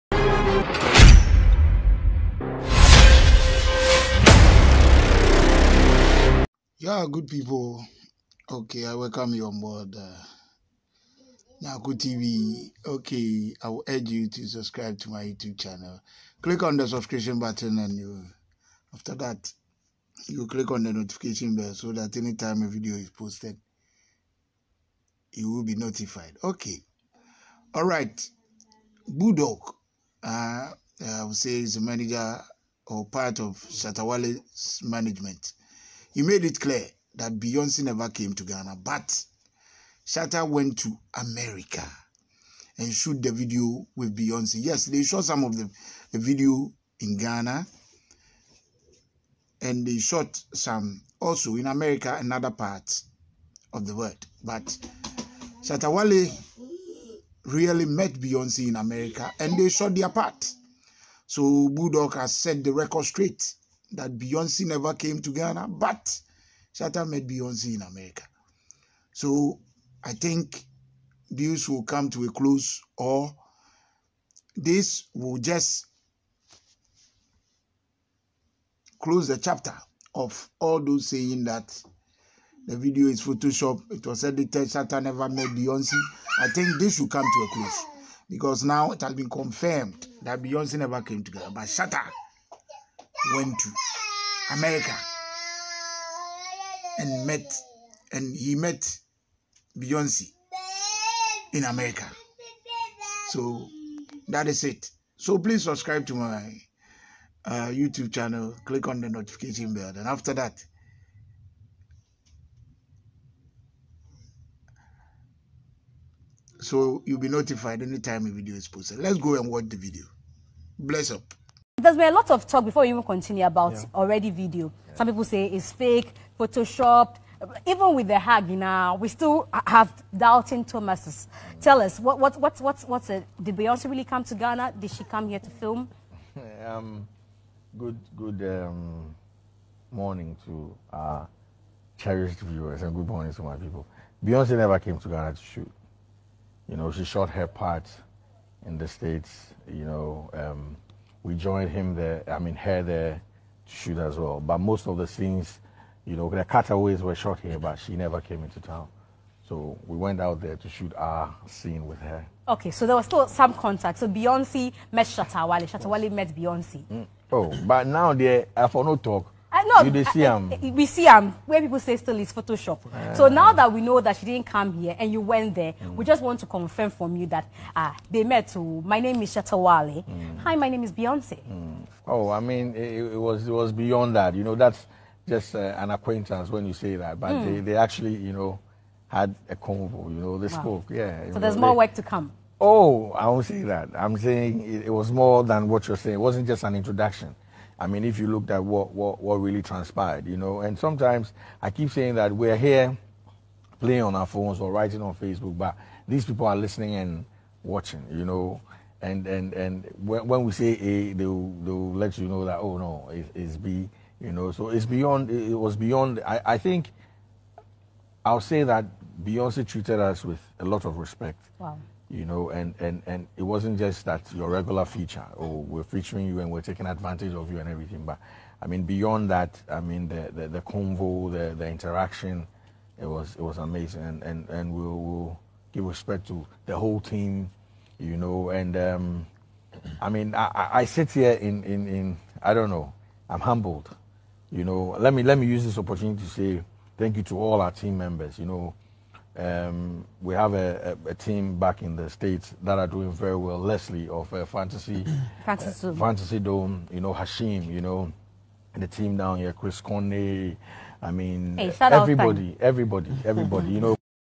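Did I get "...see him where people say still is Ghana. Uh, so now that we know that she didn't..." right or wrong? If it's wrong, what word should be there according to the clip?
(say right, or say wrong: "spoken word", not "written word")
wrong: "Photoshop", not "Ghana".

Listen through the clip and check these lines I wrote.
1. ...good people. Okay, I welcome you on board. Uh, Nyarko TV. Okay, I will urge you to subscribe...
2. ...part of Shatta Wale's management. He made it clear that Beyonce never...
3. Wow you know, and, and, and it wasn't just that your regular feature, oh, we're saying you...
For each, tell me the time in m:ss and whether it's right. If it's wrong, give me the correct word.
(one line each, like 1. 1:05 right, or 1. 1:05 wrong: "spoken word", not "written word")
1. 0:07 right
2. 0:33 right
3. 3:41 wrong: "featuring", not "saying".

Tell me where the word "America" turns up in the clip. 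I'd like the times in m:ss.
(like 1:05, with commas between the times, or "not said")
0:41, 0:51, 0:58, 1:07, 1:34, 1:41.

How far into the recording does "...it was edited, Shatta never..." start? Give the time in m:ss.
1:23.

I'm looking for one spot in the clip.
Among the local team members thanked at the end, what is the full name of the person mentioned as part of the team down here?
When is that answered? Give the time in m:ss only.
4:19.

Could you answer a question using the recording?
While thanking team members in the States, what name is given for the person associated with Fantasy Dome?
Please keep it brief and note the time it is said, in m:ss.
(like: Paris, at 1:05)
Leslie, at 4:13.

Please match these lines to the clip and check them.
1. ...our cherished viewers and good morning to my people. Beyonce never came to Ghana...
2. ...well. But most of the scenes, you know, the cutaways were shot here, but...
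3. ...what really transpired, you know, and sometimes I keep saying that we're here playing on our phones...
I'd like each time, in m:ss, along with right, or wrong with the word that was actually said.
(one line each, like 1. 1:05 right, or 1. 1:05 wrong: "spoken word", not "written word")
1. 2:20 right
2. 2:34 right
3. 3:19 right.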